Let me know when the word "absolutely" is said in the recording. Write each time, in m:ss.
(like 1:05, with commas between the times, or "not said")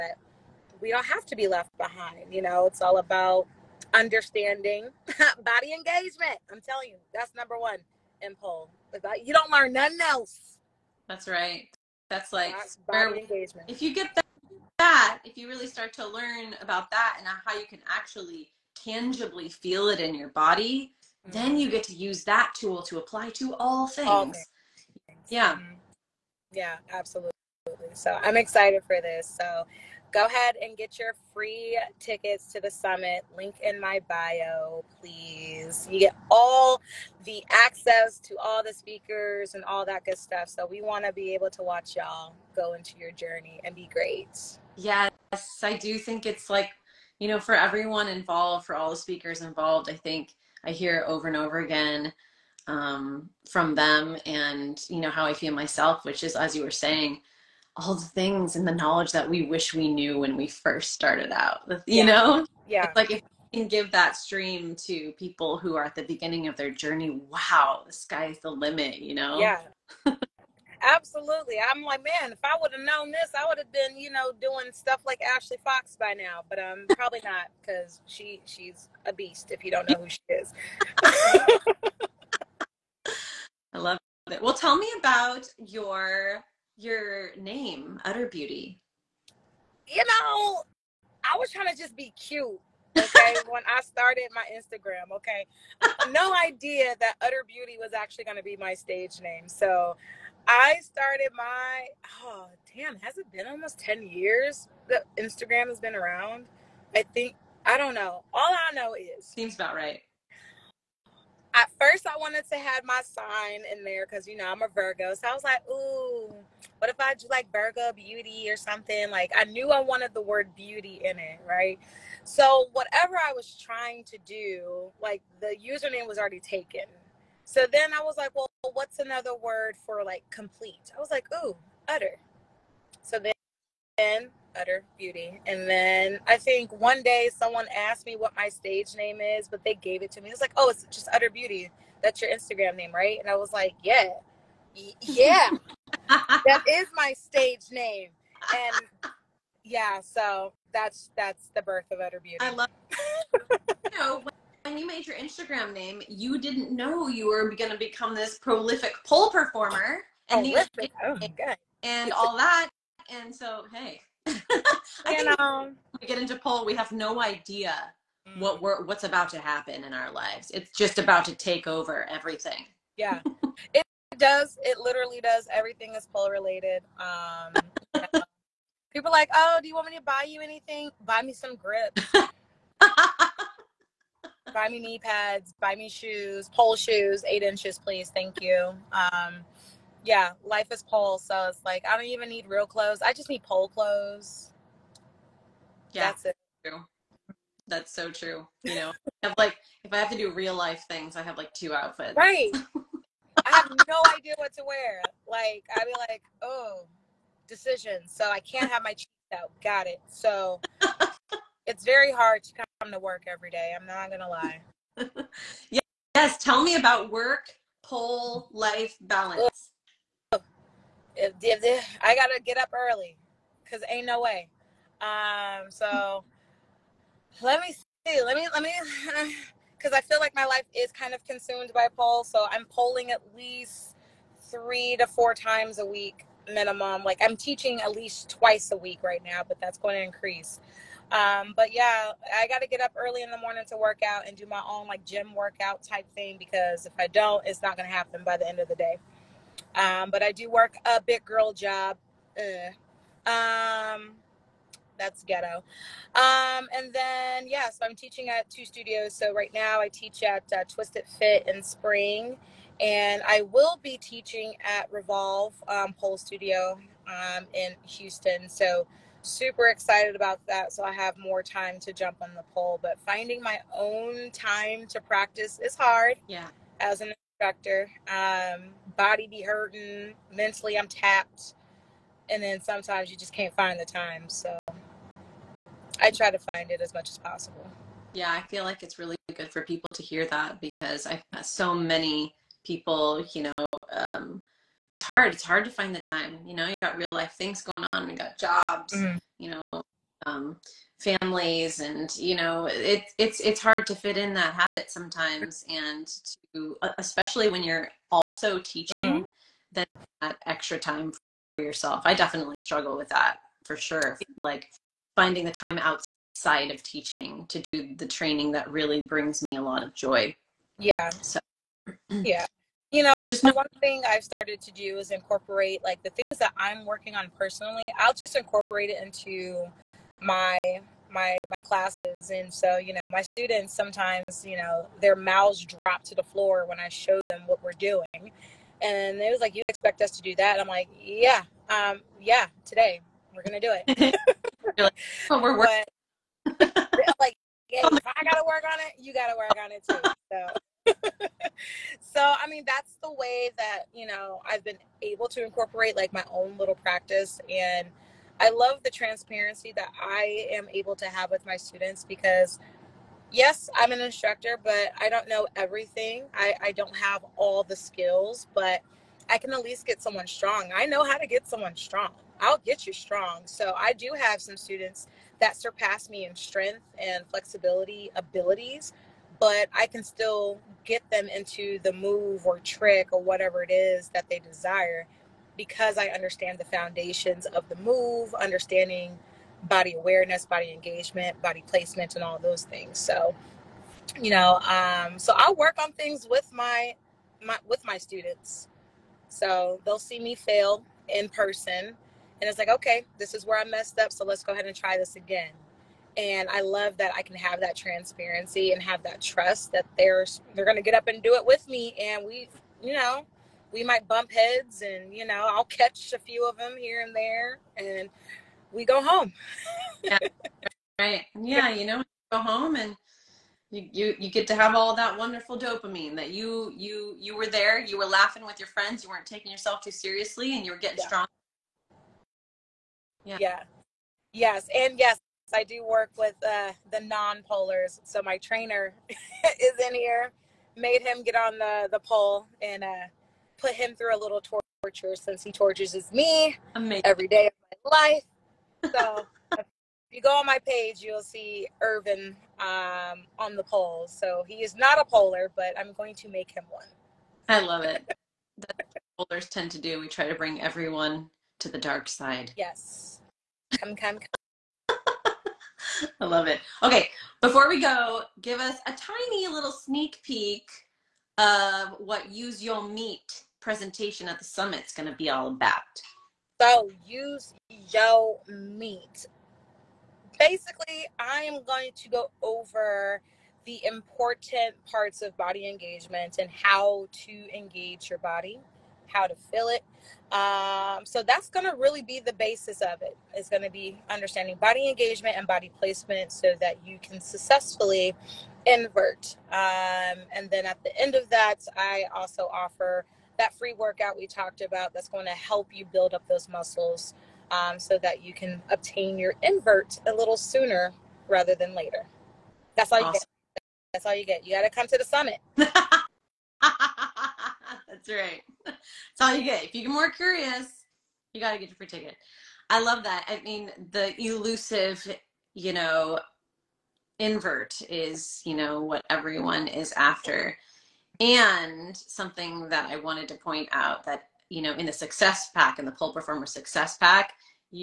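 0:26, 1:10.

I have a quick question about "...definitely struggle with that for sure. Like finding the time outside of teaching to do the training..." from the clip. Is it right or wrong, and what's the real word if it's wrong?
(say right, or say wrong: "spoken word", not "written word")
right.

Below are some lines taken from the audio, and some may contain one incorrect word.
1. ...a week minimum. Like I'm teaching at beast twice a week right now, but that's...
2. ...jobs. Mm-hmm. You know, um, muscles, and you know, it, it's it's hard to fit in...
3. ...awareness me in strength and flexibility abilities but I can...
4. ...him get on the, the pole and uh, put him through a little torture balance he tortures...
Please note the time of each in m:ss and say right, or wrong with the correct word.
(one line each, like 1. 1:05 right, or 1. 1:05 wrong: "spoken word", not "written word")
1. 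3:55 wrong: "least", not "beast"
2. 4:58 wrong: "families", not "muscles"
3. 6:15 wrong: "surpass", not "awareness"
4. 7:21 wrong: "since", not "balance".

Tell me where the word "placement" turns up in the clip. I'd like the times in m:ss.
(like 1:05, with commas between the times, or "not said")
6:31, 8:15.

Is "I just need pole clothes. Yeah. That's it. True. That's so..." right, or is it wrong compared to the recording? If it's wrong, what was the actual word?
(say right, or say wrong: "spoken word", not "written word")
right.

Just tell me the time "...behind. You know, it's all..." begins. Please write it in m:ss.
0:01.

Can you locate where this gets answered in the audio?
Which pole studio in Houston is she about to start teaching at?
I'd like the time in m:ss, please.
4:24.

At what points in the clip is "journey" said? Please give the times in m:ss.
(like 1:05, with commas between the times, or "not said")
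0:43, 1:06.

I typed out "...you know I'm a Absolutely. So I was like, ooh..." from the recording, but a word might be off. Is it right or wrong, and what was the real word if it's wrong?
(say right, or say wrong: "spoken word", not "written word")
wrong: "Virgo", not "Absolutely".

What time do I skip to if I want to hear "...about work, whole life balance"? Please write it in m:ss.
3:36.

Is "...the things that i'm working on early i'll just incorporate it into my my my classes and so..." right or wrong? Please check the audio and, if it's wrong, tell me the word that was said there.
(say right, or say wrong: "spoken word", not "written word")
wrong: "personally", not "early".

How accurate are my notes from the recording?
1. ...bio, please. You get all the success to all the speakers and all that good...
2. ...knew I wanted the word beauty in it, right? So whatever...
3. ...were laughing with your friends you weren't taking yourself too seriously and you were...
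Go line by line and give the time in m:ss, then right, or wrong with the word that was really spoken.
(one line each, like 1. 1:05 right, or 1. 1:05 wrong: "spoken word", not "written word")
1. 0:34 wrong: "access", not "success"
2. 1:59 right
3. 7:07 right.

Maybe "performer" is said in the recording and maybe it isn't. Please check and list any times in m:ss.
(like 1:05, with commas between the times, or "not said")
2:39, 8:56.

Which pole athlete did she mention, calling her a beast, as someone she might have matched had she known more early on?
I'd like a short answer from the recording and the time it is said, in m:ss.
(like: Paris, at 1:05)
Ashley Fox, at 1:15.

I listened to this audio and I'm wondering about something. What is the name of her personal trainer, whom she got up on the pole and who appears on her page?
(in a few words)
Irvin.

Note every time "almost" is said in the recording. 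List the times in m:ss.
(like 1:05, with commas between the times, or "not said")
1:43.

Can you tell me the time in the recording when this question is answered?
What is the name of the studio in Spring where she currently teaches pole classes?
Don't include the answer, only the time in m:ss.
4:20.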